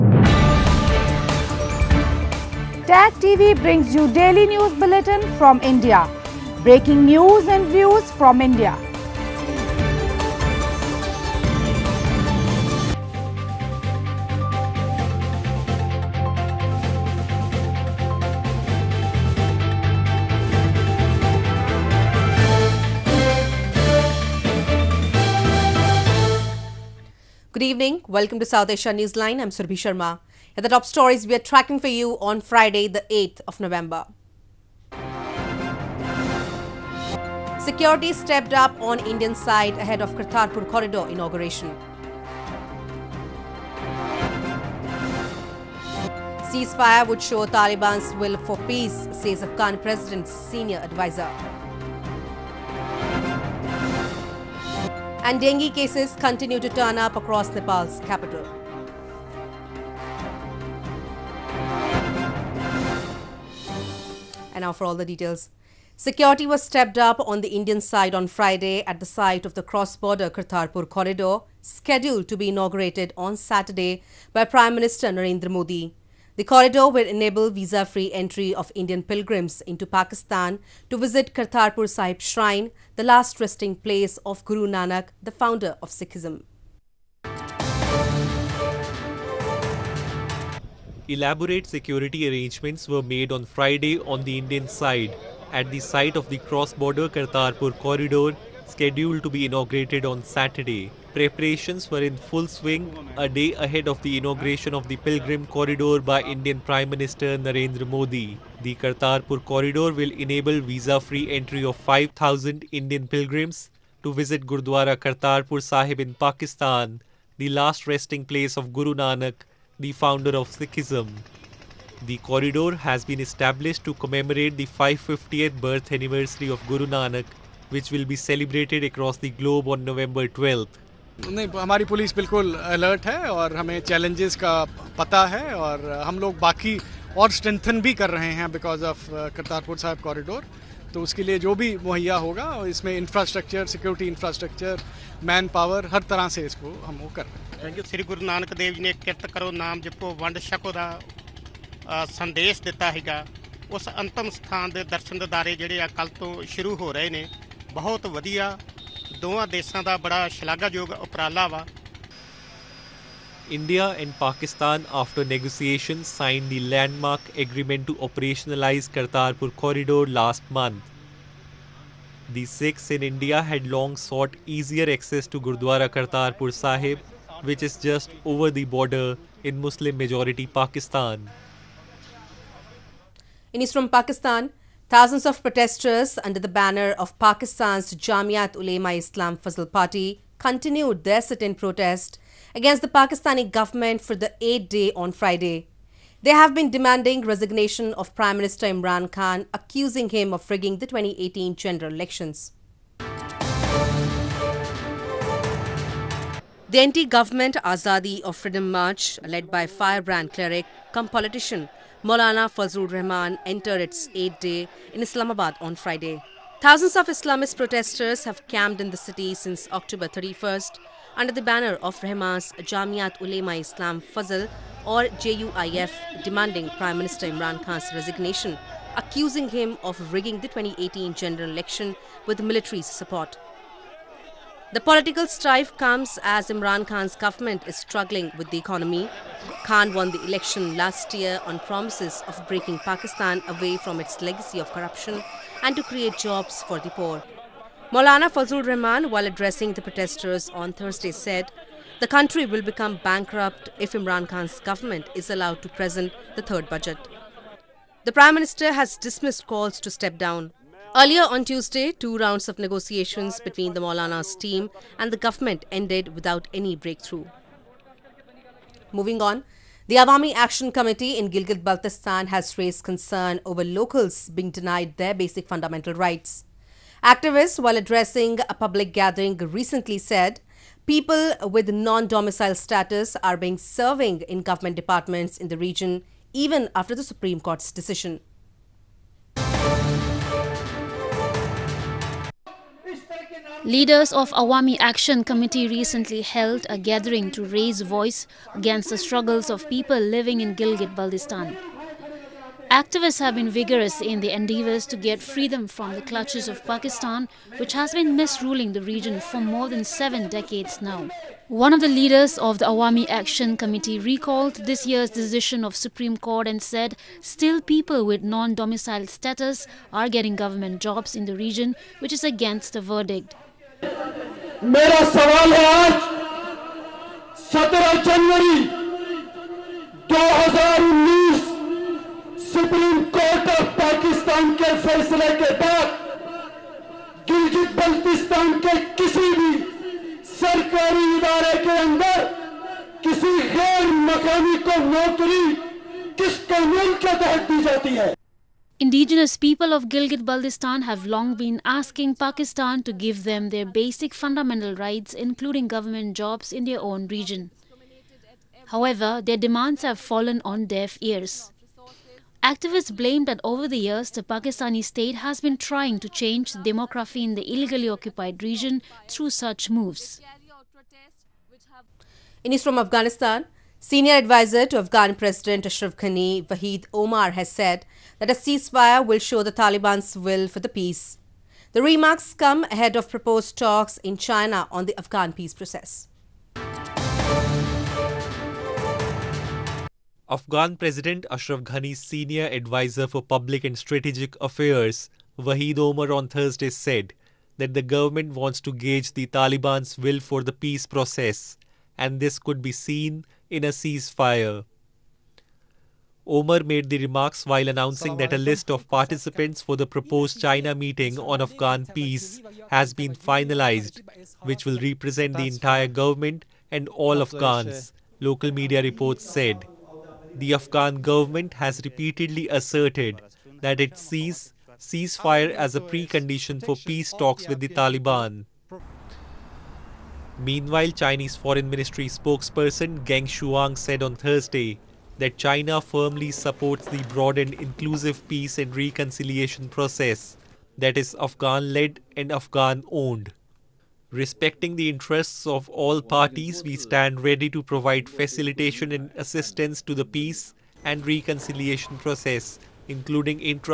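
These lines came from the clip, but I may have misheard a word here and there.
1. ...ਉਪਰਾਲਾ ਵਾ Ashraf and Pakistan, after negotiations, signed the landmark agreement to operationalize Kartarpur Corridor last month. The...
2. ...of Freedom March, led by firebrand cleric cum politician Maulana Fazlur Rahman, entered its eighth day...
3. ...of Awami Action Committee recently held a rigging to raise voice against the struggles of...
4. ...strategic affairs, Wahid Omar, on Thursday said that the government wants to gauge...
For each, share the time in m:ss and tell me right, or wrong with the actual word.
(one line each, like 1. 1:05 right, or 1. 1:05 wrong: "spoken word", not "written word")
1. 2:41 wrong: "India", not "Ashraf"
2. 3:28 right
3. 4:54 wrong: "gathering", not "rigging"
4. 6:33 right.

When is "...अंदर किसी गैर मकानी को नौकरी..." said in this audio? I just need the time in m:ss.
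5:41.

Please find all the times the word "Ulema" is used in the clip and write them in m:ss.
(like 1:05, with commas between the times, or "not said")
3:08, 3:43.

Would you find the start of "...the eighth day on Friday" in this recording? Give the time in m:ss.
3:14.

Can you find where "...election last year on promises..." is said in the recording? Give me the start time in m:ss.
4:00.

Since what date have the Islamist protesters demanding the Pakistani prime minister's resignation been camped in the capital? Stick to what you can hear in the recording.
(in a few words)
October 31st.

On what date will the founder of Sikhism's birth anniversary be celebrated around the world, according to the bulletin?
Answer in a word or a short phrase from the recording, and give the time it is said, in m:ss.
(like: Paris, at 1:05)
November 12th, at 2:09.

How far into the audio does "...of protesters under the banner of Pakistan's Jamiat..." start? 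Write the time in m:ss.
3:05.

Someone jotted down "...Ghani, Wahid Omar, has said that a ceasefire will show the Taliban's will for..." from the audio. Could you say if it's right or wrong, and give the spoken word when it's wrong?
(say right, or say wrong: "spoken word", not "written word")
right.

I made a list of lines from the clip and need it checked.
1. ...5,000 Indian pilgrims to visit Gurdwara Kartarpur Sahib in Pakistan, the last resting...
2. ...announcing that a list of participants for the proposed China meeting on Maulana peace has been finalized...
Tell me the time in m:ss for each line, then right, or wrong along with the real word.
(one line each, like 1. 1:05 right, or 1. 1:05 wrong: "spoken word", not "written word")
1. 1:51 right
2. 6:47 wrong: "Afghan", not "Maulana".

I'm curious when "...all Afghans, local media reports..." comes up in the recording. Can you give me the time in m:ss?
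6:56.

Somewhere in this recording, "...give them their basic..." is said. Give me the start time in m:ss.
5:53.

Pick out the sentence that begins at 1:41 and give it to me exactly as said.
Preparations were in full swing a day ahead of the inauguration of the Pilgrim Corridor by Indian Prime Minister Narendra Modi.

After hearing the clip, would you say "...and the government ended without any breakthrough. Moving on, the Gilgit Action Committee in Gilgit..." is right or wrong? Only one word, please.
wrong.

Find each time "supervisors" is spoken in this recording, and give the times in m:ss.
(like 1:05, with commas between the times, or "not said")
not said.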